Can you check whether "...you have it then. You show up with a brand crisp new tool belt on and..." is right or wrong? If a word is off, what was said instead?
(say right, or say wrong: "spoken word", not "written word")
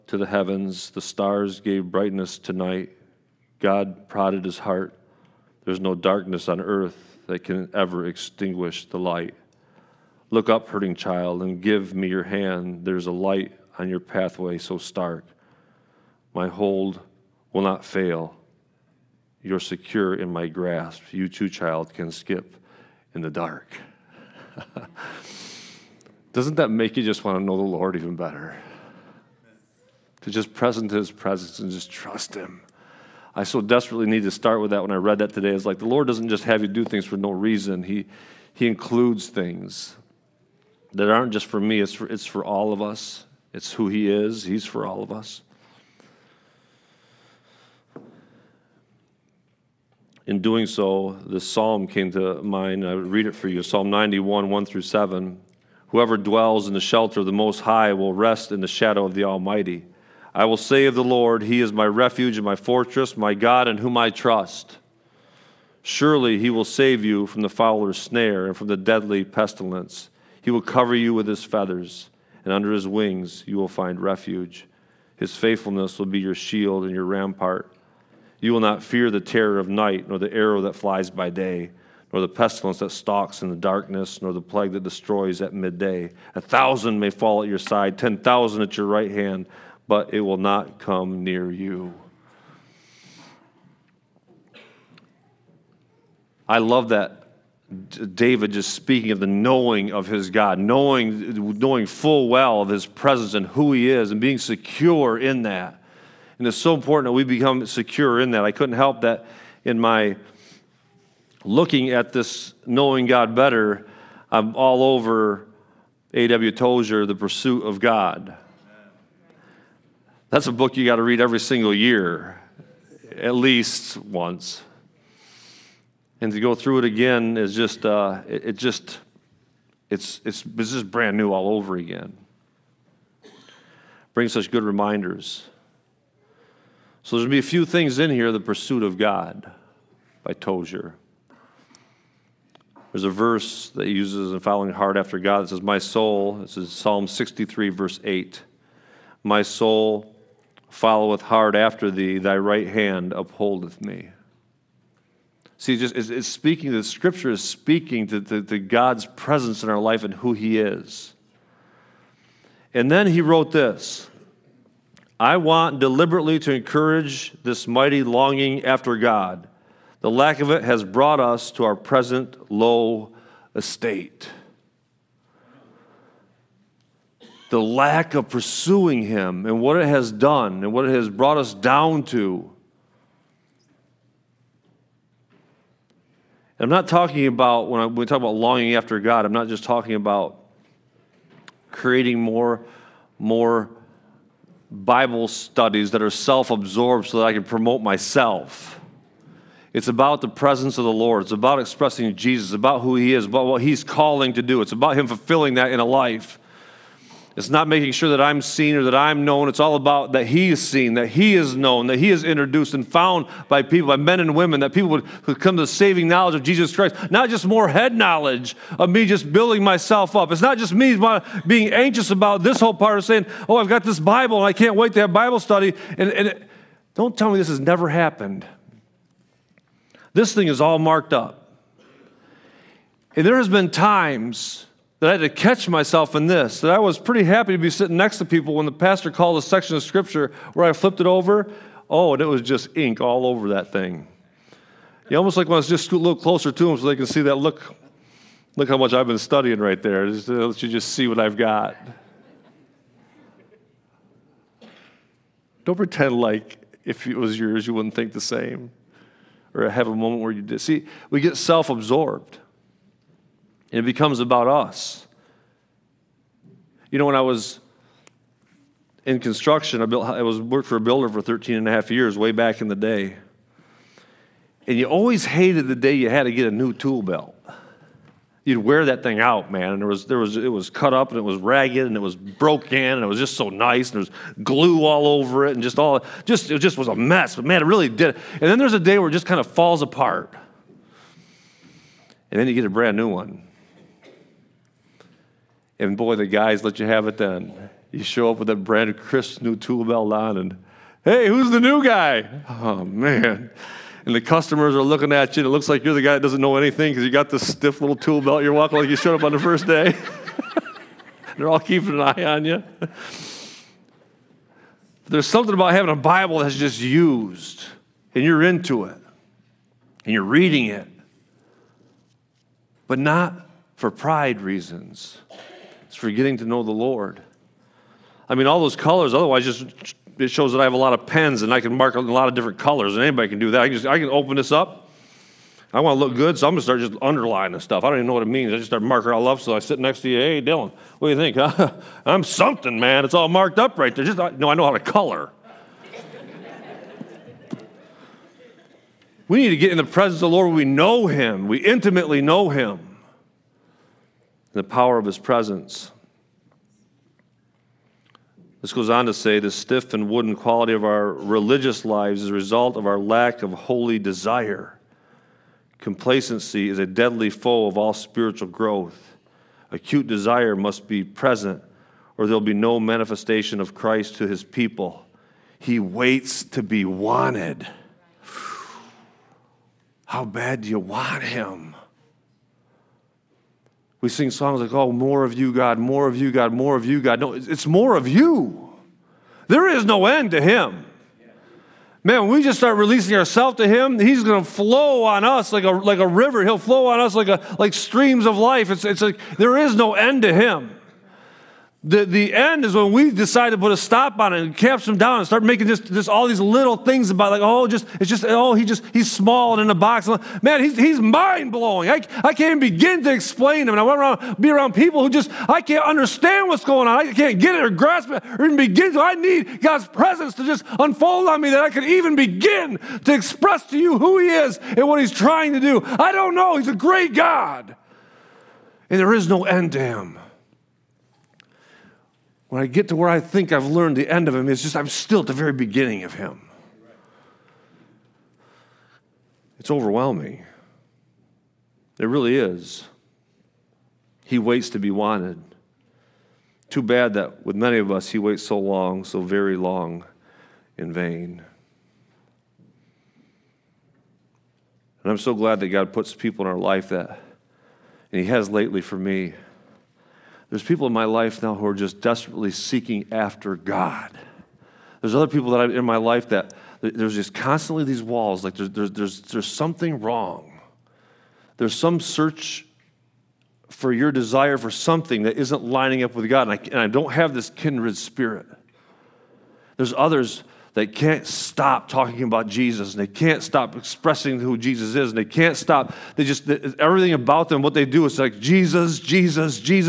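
right.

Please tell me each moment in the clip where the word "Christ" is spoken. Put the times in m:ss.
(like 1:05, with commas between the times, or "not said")
3:36, 6:13.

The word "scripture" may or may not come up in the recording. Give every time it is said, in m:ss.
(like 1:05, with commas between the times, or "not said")
2:36, 3:59.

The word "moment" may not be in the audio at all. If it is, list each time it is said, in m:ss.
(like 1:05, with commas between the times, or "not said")
4:19.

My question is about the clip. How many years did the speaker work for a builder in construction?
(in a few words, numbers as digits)
13 and a half.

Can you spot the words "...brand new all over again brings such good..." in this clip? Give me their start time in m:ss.
2:10.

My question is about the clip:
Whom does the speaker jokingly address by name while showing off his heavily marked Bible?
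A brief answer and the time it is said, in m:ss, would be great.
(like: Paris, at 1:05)
Dylan, at 5:40.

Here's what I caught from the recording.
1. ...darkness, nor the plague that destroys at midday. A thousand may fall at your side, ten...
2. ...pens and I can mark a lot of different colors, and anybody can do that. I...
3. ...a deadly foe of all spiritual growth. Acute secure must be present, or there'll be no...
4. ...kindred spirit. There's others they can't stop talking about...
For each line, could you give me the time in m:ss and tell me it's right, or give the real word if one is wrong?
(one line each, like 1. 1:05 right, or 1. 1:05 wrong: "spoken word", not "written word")
1. 1:23 right
2. 5:31 right
3. 6:06 wrong: "desire", not "secure"
4. 7:57 right.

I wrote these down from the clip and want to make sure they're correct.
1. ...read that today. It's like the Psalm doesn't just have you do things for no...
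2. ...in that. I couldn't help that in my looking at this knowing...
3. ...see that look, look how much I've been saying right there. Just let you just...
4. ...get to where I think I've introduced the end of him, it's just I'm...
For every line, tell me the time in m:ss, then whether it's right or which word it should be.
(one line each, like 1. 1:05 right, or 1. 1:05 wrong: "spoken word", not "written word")
1. 0:34 wrong: "Lord", not "Psalm"
2. 1:48 right
3. 4:07 wrong: "studying", not "saying"
4. 7:12 wrong: "learned", not "introduced".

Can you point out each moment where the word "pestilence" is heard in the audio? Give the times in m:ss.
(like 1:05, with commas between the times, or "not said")
1:09, 1:22.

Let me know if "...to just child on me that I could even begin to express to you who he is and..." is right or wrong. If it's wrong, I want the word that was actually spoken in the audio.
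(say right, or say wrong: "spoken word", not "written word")
wrong: "unfold", not "child".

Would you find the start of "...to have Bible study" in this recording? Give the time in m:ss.
3:44.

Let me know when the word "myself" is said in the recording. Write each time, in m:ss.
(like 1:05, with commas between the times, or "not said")
3:17, 3:39, 3:55.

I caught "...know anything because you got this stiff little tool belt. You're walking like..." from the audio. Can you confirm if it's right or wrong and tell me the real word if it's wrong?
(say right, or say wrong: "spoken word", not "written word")
right.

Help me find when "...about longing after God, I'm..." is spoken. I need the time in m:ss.
3:08.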